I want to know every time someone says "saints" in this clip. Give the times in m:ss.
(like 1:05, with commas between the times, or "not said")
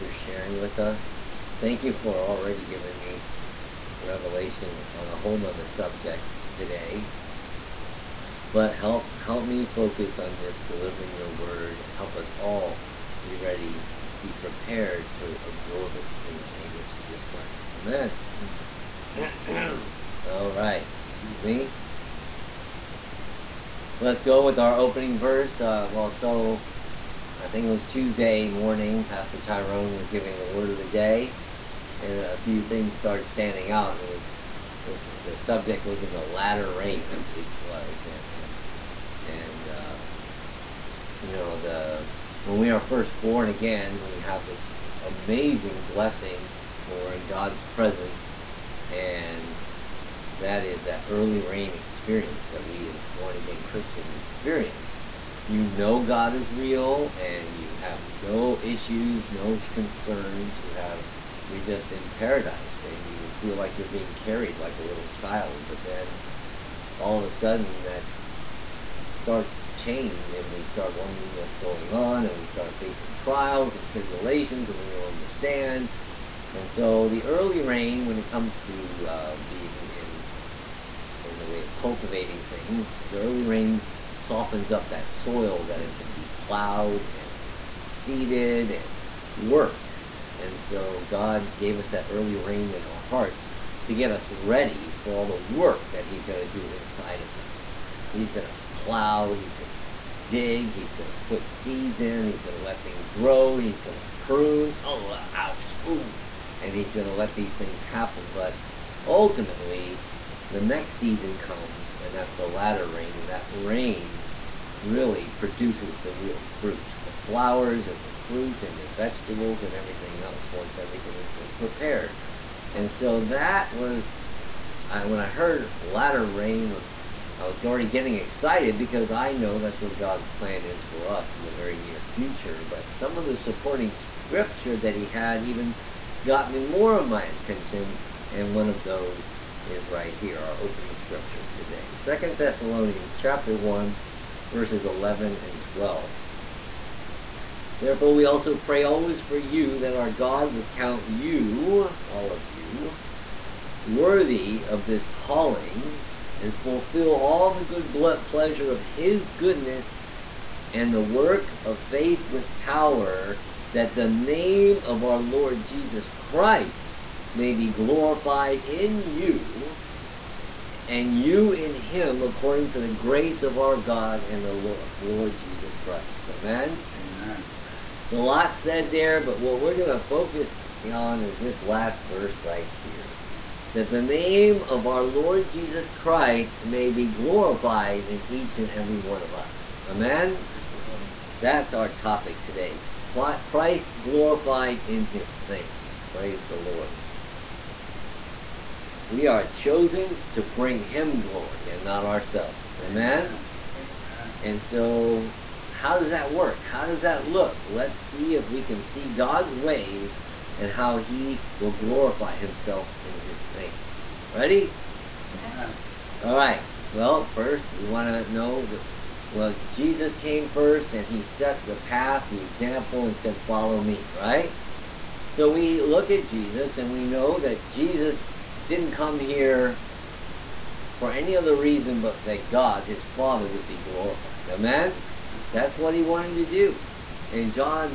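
3:15, 3:33.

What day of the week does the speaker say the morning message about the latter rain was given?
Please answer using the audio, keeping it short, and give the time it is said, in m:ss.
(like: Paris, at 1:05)
Tuesday, at 0:27.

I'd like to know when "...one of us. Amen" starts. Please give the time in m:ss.
3:09.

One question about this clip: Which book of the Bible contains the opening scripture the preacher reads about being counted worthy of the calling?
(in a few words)
Second Thessalonians.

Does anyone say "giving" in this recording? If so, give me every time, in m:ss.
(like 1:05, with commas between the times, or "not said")
0:02, 0:30.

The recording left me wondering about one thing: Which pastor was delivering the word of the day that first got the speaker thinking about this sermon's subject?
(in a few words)
Pastor Tyrone.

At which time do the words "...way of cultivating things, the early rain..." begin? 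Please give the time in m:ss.
1:21.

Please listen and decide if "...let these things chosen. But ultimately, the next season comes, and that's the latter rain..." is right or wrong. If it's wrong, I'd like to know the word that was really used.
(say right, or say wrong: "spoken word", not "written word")
wrong: "happen", not "chosen".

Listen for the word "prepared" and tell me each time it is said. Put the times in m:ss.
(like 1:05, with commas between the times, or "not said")
0:14, 2:01.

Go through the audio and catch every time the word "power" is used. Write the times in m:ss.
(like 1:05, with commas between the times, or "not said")
2:42.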